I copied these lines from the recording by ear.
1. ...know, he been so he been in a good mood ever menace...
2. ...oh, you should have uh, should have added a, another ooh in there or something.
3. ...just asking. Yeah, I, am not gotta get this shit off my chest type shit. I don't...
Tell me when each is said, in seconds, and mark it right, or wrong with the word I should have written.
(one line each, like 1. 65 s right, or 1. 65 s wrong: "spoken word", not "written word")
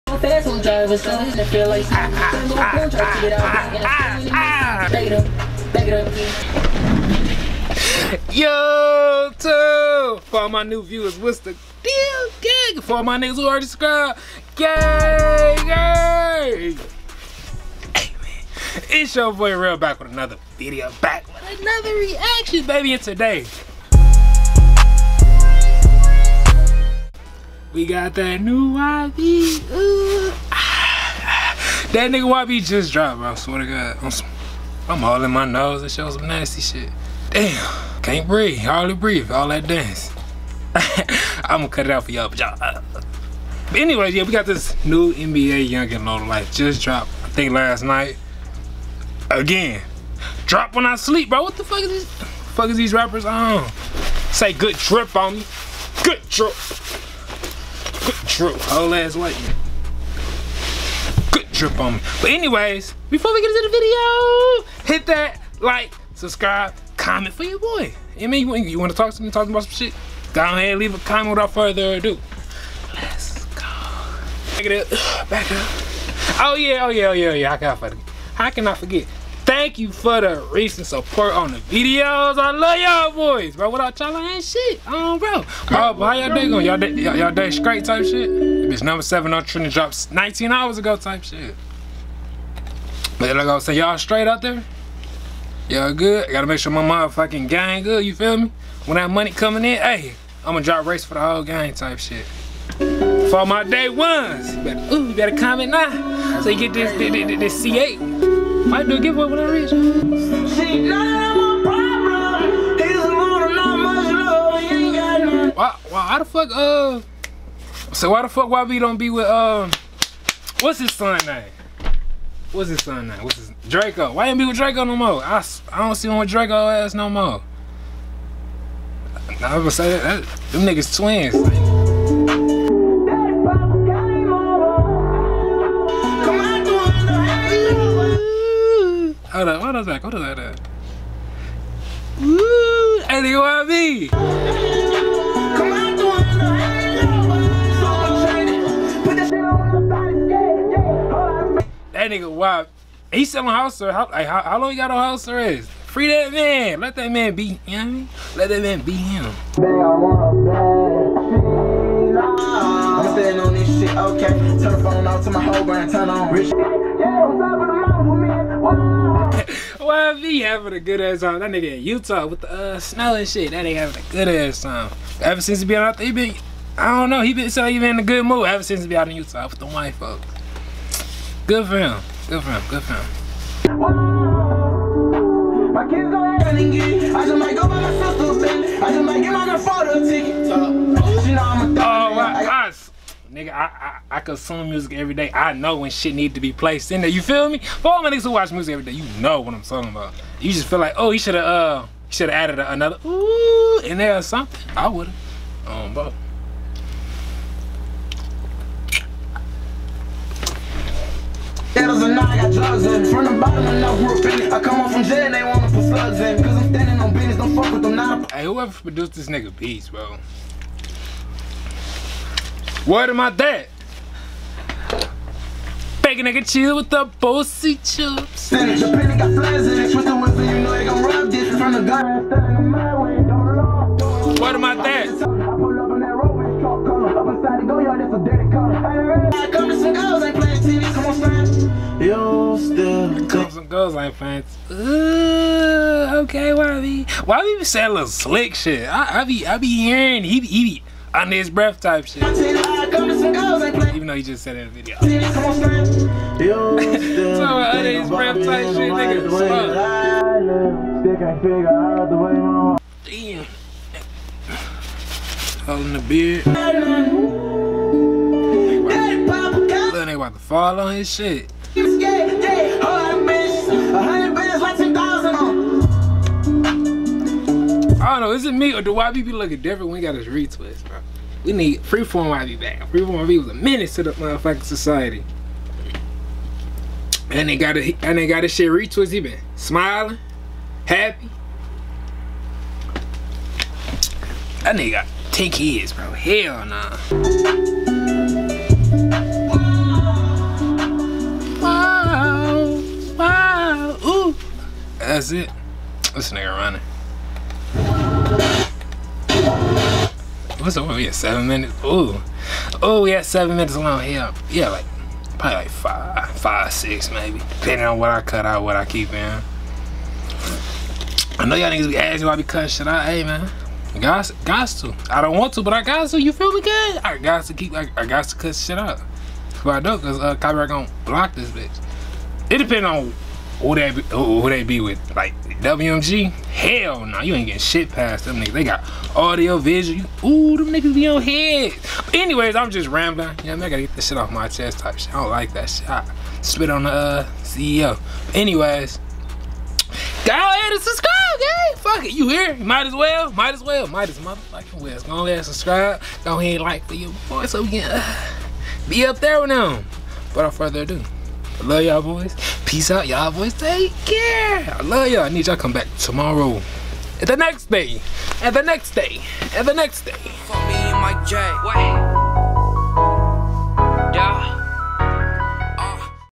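1. 177 s wrong: "since", not "menace"
2. 200 s right
3. 342 s wrong: "rambling", not "asking".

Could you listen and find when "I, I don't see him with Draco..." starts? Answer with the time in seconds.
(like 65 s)
125 s.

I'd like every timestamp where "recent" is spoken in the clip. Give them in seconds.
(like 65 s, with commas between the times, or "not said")
80 s.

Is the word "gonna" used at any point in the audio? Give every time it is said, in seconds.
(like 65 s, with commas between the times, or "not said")
41 s, 100 s, 129 s, 330 s.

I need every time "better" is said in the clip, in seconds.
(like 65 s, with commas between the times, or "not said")
105 s.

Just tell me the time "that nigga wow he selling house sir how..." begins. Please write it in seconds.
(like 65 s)
151 s.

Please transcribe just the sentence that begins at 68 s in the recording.
You mean you, want to talk something, talk about some shit?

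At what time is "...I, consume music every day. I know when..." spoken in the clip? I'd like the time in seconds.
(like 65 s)
194 s.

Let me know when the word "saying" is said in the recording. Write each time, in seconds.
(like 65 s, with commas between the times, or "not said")
93 s, 247 s.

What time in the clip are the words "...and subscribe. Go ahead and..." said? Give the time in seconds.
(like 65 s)
355 s.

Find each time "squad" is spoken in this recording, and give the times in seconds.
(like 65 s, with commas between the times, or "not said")
not said.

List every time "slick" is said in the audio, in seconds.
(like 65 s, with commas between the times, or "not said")
248 s.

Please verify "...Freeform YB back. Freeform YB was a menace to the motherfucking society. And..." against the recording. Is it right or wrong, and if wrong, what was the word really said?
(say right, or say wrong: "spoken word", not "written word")
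right.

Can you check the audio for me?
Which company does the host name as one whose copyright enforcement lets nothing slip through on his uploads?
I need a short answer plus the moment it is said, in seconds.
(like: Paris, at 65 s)
WMG, at 335 s.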